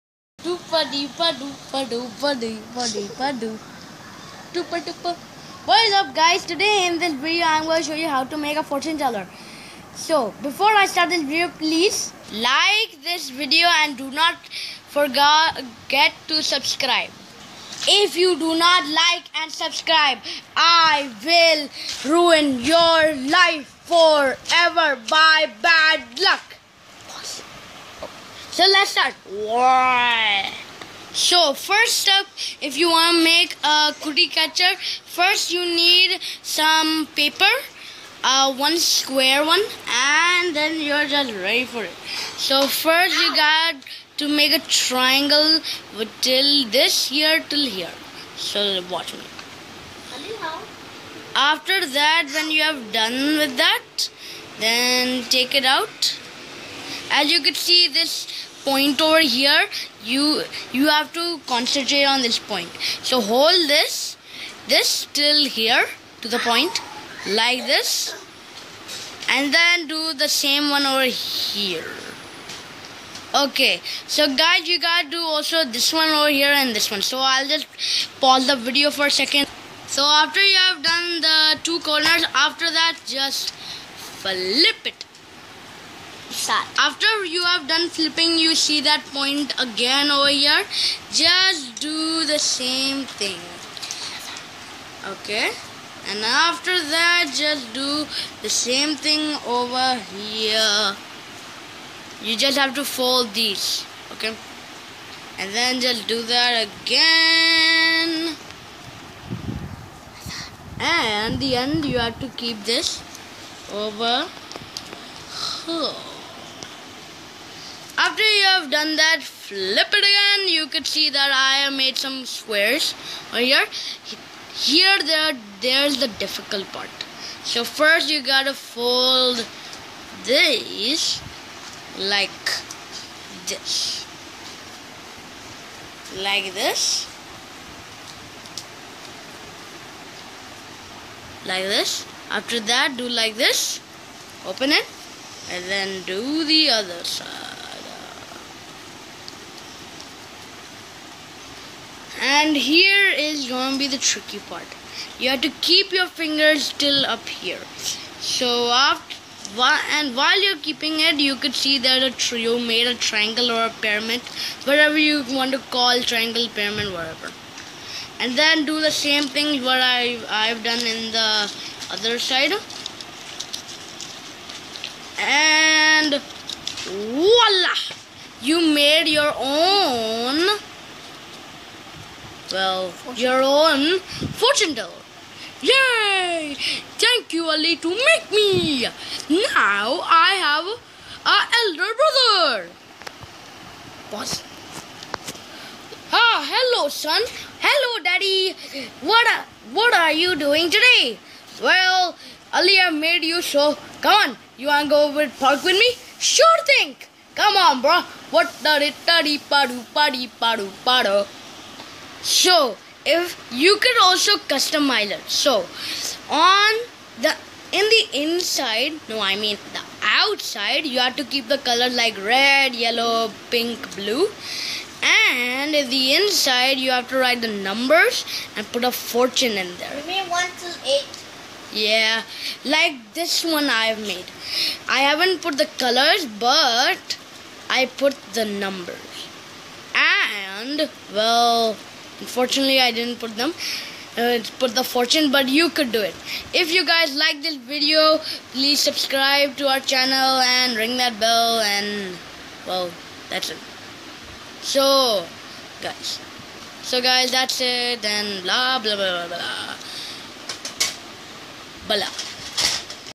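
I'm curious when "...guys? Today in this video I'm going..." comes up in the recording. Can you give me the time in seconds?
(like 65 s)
6 s.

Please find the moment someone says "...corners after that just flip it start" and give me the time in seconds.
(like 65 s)
81 s.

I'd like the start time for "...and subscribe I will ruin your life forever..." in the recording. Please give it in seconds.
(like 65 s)
19 s.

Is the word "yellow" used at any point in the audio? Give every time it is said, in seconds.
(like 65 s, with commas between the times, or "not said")
222 s.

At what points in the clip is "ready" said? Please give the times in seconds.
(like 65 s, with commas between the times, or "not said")
41 s.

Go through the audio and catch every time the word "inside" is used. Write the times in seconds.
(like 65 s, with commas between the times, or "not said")
218 s, 226 s.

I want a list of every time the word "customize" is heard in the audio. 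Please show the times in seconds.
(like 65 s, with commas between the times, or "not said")
214 s.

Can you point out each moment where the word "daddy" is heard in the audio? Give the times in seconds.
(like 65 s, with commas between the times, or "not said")
198 s, 209 s.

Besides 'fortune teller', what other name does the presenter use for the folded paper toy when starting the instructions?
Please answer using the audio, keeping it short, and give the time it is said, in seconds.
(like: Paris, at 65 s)
cookie catcher, at 34 s.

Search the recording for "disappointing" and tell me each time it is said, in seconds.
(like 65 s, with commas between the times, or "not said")
not said.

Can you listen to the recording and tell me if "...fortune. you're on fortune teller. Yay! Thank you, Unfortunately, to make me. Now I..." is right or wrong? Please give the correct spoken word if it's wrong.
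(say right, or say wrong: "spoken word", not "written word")
wrong: "Ali", not "Unfortunately".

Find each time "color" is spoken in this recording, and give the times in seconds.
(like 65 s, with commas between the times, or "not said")
221 s, 235 s.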